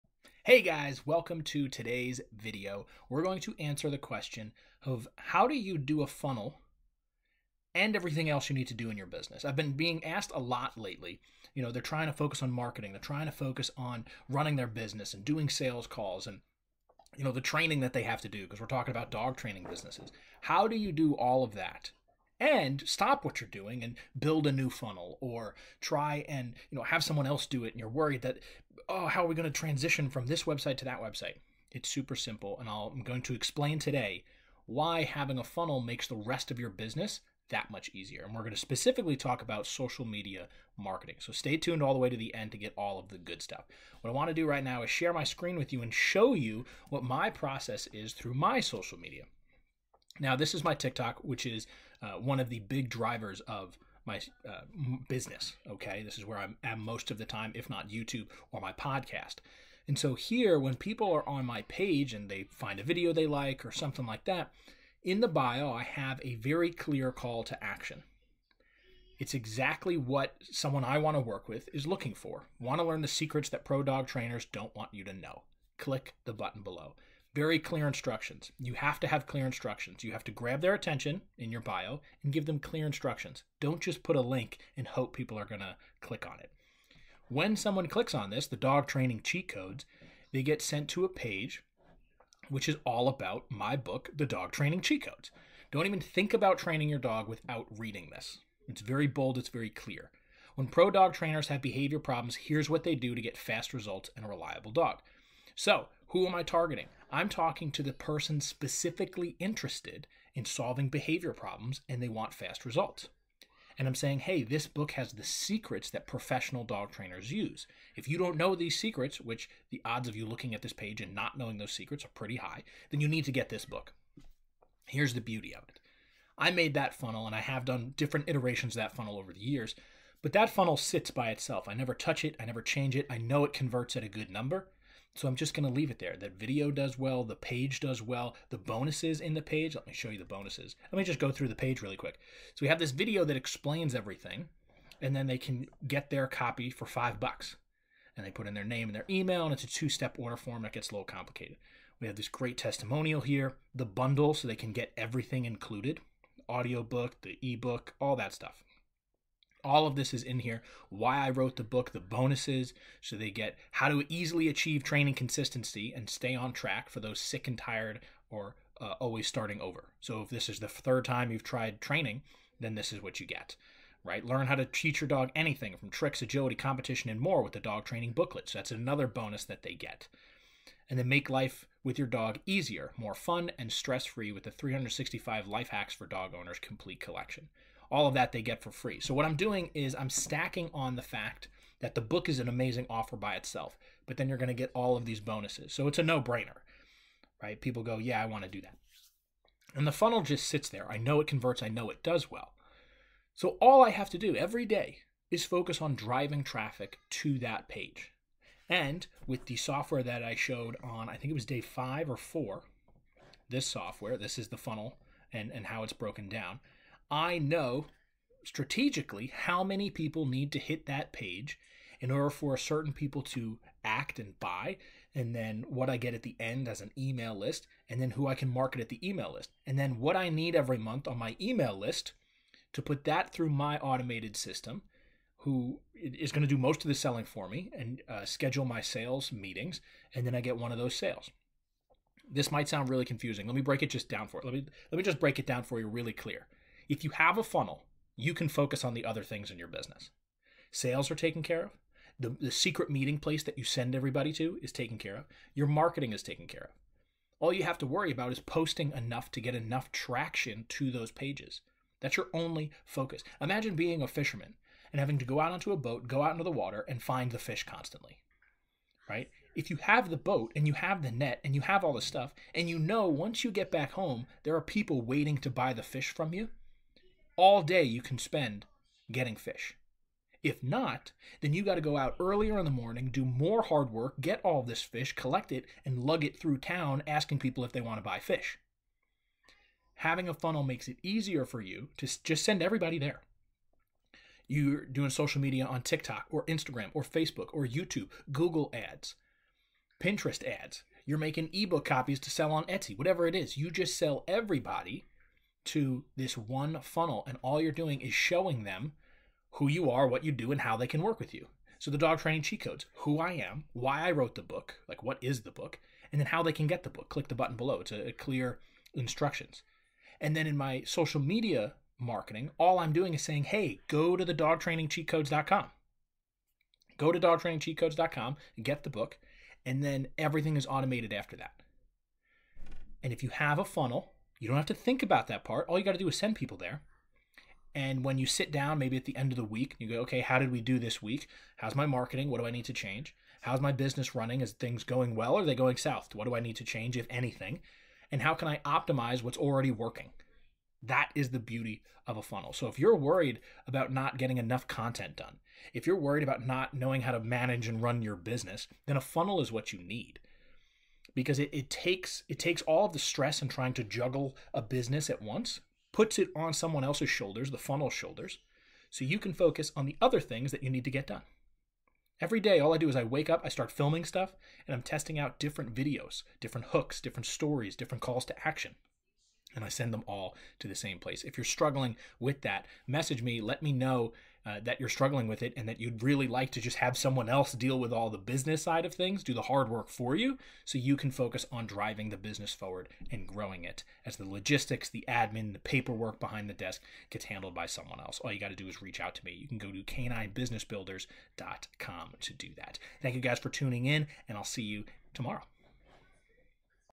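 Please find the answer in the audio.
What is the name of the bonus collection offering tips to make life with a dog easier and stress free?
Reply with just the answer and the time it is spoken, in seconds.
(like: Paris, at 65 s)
365 Life Hacks for Dog Owners, at 184 s.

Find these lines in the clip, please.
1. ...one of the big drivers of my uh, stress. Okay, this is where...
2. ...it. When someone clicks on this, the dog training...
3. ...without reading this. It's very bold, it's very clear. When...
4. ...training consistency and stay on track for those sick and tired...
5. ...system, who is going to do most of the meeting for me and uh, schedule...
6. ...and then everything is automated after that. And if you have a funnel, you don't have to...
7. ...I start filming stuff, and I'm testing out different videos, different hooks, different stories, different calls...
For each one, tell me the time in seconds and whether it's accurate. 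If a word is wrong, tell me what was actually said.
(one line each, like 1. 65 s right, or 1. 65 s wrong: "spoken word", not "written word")
1. 52 s wrong: "business", not "stress"
2. 86 s right
3. 97 s right
4. 164 s right
5. 234 s wrong: "selling", not "meeting"
6. 329 s right
7. 373 s right.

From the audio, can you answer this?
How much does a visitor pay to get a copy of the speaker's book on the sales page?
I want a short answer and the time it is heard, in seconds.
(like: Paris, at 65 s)
5 bucks, at 146 s.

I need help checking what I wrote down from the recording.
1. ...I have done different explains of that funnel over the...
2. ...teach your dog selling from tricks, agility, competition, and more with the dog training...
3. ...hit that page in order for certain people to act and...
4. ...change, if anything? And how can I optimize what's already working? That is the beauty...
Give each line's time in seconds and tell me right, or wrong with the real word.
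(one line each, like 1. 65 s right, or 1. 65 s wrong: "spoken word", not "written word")
1. 127 s wrong: "iterations", not "explains"
2. 174 s wrong: "anything", not "selling"
3. 220 s right
4. 346 s right.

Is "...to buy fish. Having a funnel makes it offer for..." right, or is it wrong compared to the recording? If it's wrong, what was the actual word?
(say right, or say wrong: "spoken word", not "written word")
wrong: "easier", not "offer".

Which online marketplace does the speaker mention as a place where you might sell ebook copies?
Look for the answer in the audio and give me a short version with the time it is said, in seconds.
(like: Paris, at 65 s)
Etsy, at 302 s.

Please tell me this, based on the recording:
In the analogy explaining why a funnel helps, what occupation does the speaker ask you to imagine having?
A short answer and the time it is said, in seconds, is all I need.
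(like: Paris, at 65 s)
Fisherman, at 264 s.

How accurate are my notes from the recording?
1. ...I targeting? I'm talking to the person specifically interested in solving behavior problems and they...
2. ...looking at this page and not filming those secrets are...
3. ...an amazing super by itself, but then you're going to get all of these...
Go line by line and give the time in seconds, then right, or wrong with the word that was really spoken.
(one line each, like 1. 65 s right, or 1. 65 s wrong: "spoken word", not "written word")
1. 106 s right
2. 120 s wrong: "knowing", not "filming"
3. 192 s wrong: "offer", not "super".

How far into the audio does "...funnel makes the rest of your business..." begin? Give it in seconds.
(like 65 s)
35 s.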